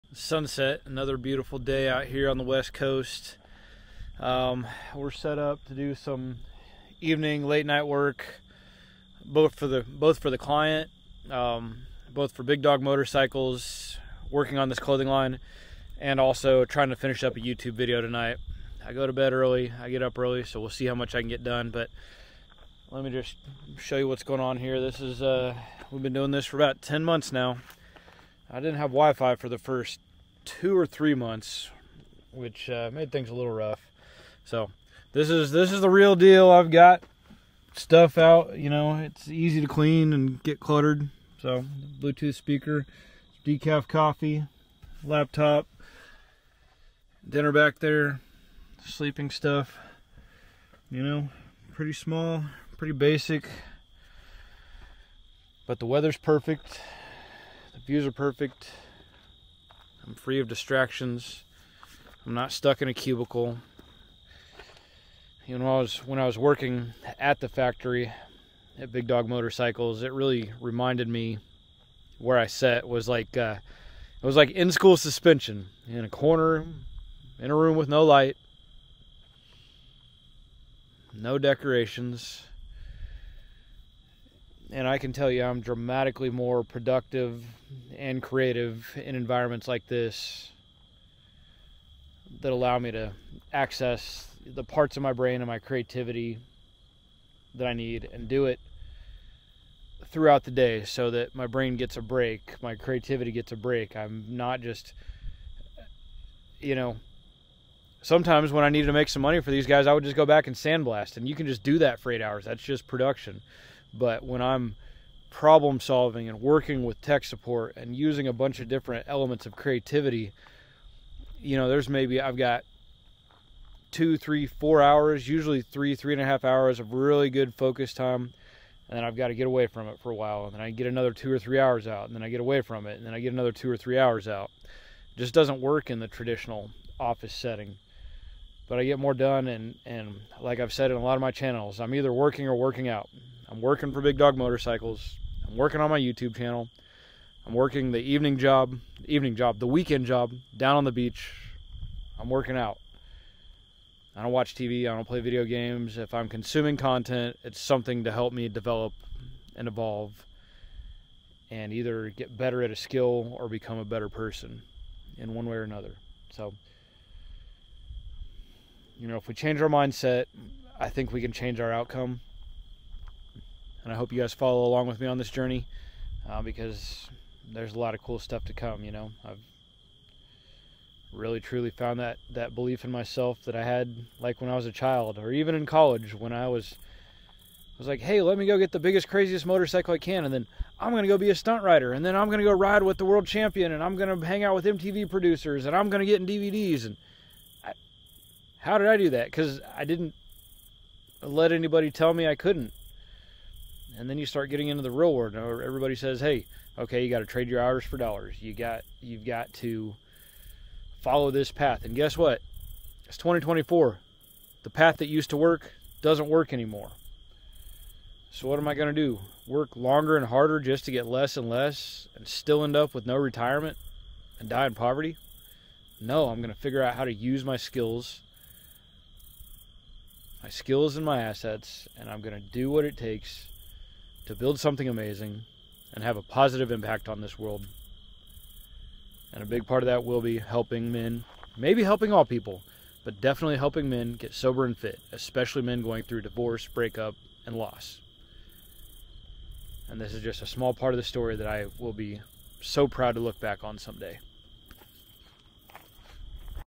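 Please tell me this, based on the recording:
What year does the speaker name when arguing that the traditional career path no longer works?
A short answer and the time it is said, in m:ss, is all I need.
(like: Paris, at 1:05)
2024, at 3:33.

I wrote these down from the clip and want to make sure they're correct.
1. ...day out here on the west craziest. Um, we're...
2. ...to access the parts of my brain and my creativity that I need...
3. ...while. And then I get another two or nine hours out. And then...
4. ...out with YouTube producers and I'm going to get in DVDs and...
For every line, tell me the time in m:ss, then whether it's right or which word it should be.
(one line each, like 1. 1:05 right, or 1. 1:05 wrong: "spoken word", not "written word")
1. 0:01 wrong: "coast", not "craziest"
2. 1:32 right
3. 2:10 wrong: "three", not "nine"
4. 3:14 wrong: "MTV", not "YouTube".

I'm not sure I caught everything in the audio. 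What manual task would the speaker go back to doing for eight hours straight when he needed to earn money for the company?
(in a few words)
Sandblast.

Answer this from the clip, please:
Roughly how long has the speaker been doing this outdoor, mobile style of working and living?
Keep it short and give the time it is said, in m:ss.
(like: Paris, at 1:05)
10 months, at 0:26.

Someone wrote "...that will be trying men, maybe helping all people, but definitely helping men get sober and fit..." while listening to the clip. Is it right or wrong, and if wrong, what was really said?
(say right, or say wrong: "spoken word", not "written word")
wrong: "helping", not "trying".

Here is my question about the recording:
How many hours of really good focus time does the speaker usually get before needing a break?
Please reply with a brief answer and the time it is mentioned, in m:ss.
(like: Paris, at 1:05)
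3.5 hours, at 2:05.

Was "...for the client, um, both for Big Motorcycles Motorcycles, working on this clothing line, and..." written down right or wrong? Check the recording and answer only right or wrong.
wrong.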